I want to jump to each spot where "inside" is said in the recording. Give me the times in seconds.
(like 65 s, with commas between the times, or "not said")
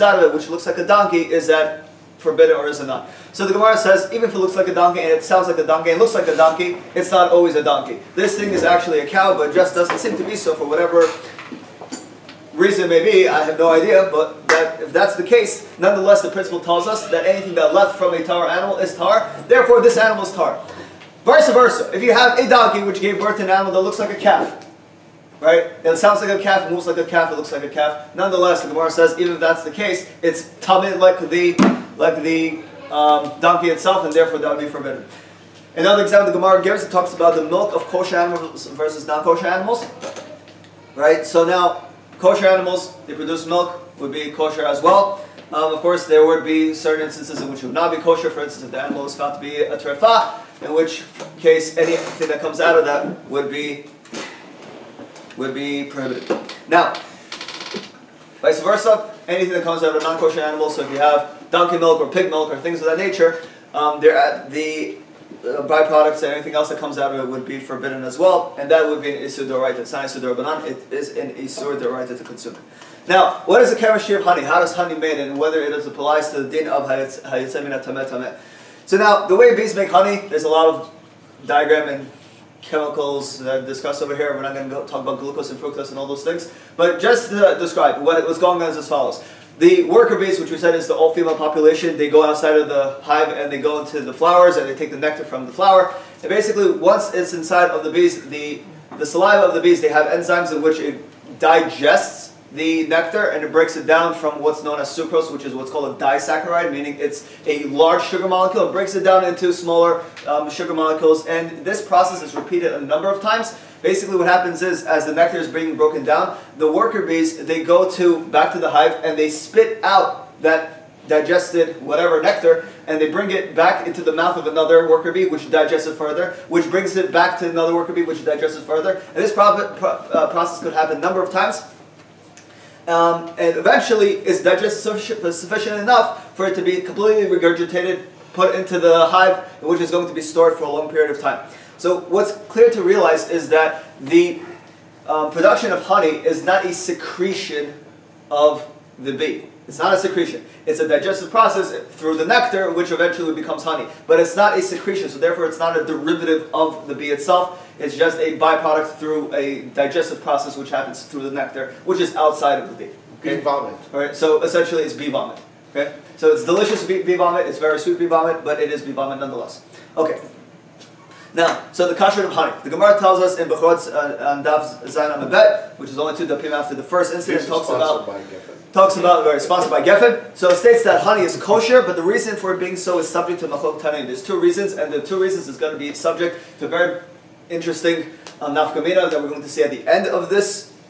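97 s.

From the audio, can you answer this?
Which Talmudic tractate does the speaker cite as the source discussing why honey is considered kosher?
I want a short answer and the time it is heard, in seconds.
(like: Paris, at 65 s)
Bechorot, at 173 s.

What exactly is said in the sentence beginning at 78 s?
So now, the way bees make honey, there's a lot of diagram and chemicals that I've discussed over here.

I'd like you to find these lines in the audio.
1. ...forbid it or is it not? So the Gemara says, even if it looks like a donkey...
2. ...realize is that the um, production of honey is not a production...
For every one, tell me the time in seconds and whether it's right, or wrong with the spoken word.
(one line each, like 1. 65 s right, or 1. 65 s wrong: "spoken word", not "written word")
1. 2 s right
2. 142 s wrong: "secretion", not "production".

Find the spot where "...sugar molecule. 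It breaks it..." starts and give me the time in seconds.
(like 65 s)
108 s.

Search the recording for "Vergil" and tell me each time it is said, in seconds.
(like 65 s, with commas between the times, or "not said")
not said.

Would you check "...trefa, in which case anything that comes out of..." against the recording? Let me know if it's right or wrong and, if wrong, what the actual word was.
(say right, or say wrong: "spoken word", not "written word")
right.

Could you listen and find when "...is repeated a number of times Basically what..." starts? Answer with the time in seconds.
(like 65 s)
112 s.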